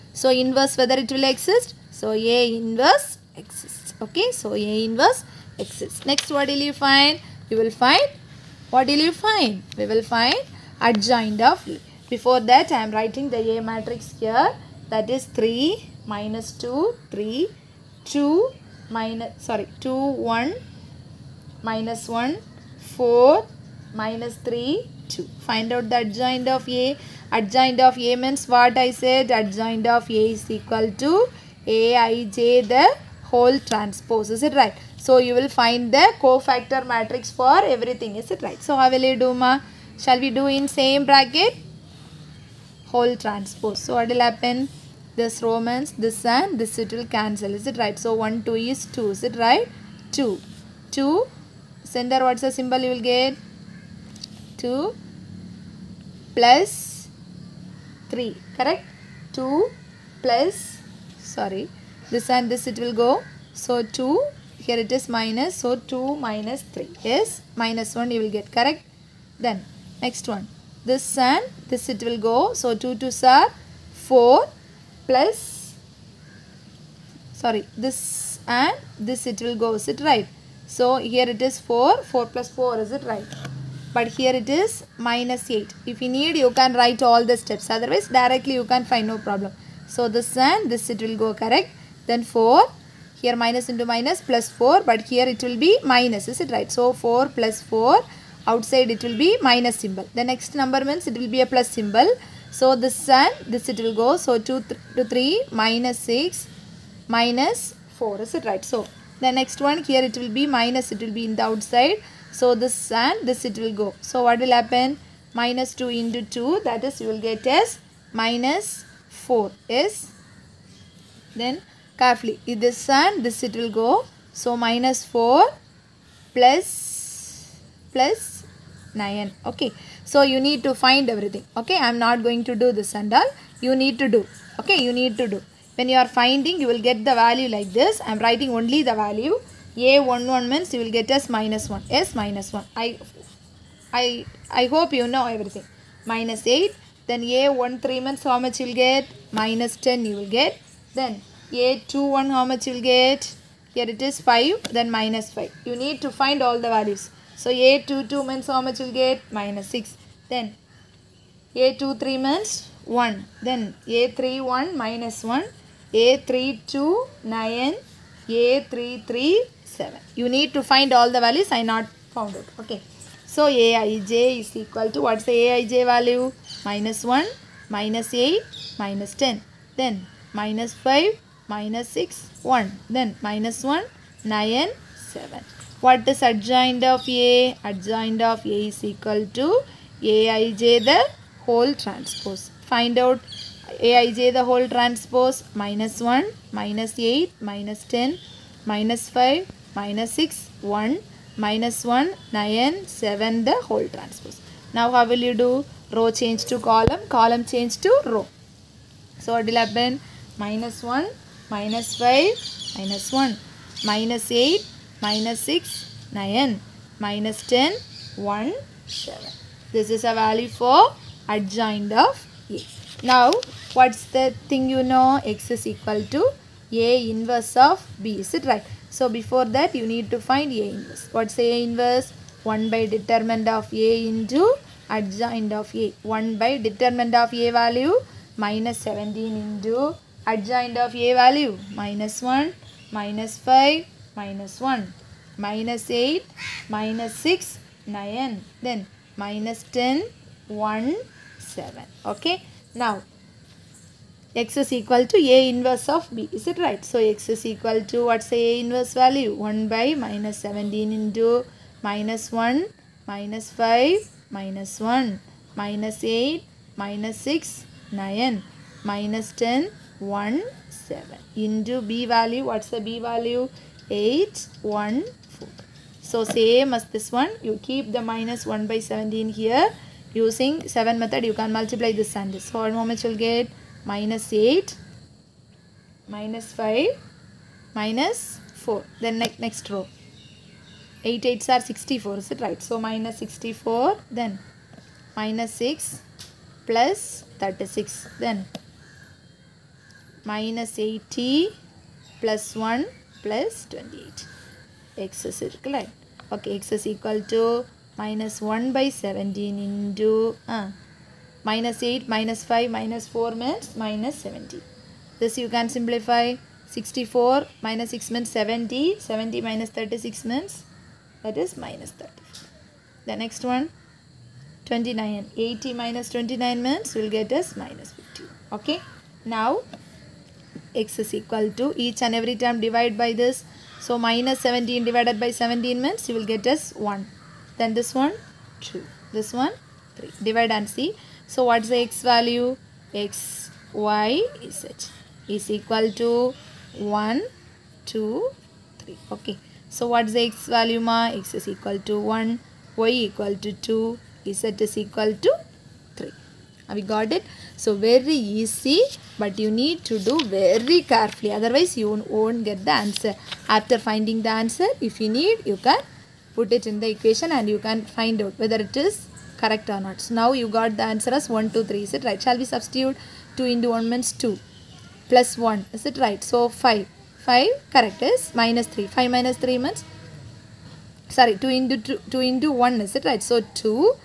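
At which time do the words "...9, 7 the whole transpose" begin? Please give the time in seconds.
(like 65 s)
202 s.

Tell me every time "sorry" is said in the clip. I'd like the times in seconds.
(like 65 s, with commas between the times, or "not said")
19 s, 61 s, 77 s, 381 s.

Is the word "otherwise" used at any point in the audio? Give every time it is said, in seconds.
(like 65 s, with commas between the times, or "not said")
87 s, 361 s.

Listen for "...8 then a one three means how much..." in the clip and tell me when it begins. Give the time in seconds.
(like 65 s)
146 s.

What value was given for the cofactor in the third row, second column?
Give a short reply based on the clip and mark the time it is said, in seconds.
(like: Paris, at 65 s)
9, at 165 s.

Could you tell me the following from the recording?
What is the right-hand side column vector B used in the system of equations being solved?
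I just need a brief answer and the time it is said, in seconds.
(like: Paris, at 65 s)
8, 1, 4, at 273 s.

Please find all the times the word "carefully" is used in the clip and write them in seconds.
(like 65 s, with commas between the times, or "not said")
122 s, 360 s.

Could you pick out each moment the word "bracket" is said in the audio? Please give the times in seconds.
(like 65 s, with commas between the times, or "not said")
41 s.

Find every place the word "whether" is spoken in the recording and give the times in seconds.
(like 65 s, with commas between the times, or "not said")
0 s, 368 s.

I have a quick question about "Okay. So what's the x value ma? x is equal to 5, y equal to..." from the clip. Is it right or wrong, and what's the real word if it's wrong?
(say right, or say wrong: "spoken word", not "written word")
wrong: "1", not "5".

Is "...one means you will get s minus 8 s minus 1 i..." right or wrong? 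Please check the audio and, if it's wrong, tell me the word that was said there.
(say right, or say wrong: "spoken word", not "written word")
wrong: "1", not "8".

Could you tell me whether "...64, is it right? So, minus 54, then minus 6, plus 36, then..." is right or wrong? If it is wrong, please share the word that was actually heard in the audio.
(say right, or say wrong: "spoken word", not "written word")
wrong: "64", not "54".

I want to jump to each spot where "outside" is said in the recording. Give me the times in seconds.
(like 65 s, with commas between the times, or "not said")
98 s, 111 s.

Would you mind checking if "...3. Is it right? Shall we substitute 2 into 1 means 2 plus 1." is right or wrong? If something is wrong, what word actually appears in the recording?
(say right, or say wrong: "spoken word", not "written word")
right.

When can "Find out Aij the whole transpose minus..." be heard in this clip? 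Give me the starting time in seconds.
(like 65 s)
192 s.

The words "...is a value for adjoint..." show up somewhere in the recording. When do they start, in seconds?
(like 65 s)
219 s.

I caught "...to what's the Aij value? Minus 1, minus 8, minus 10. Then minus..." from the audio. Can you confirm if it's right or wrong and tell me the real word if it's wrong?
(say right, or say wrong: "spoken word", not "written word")
right.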